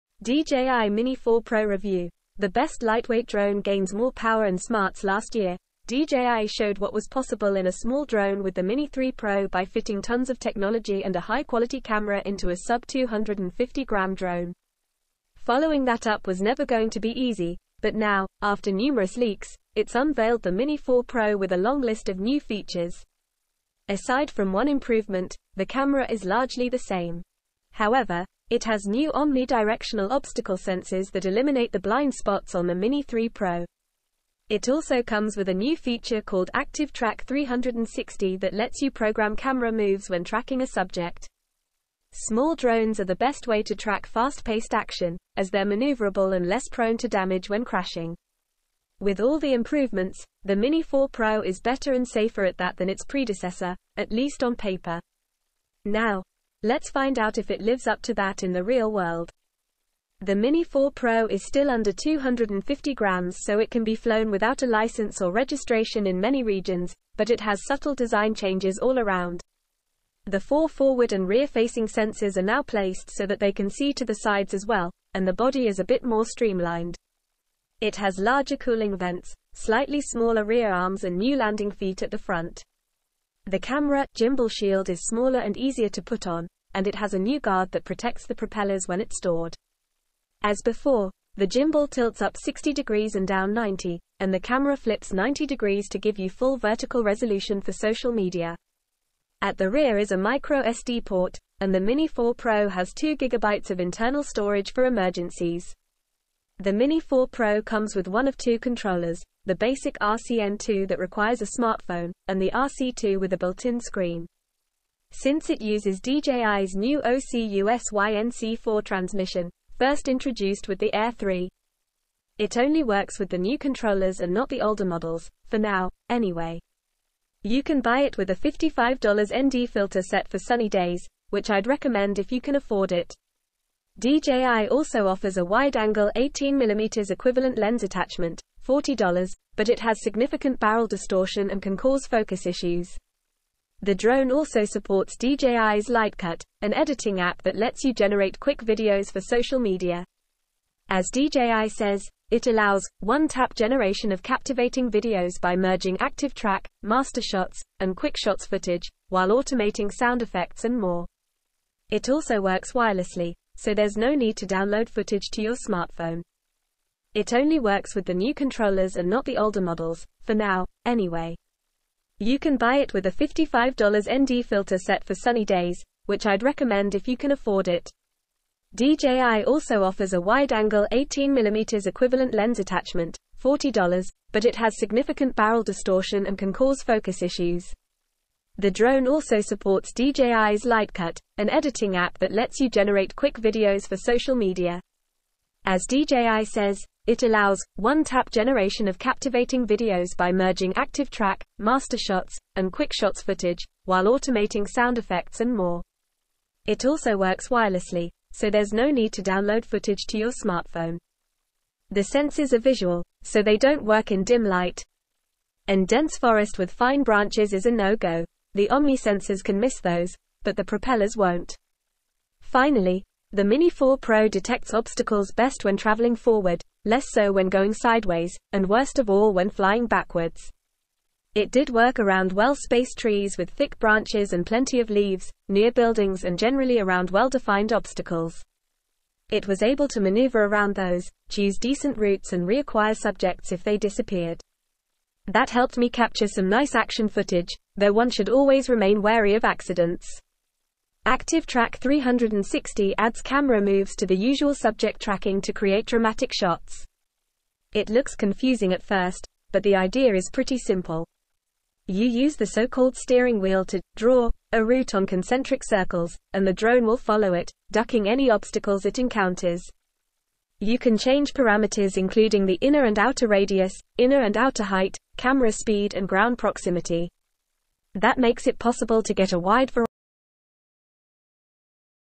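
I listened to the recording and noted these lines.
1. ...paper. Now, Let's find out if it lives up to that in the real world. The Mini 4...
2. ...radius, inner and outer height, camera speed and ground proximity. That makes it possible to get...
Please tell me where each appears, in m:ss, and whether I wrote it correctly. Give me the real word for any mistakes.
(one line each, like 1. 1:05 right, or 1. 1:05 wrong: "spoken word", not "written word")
1. 0:54 right
2. 4:33 right.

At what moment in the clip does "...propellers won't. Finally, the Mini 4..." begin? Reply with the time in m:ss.
3:40.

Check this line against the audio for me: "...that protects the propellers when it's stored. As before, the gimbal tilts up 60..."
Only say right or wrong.
right.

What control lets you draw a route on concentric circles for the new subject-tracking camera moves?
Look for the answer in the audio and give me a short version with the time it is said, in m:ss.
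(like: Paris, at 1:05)
steering wheel, at 4:22.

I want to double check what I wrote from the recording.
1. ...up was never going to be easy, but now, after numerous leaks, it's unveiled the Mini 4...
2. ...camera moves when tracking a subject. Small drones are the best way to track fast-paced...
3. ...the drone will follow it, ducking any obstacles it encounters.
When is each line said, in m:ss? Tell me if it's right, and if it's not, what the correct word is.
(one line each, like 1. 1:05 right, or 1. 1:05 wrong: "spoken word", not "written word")
1. 0:16 right
2. 0:39 right
3. 4:26 right.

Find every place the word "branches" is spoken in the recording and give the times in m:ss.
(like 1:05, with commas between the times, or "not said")
3:37, 3:53.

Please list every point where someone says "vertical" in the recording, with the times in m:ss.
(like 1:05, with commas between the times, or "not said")
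1:36.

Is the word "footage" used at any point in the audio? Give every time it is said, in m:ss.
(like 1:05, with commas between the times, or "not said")
2:38, 2:44, 3:23, 3:29, 4:07.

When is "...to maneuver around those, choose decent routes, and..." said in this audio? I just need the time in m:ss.
3:59.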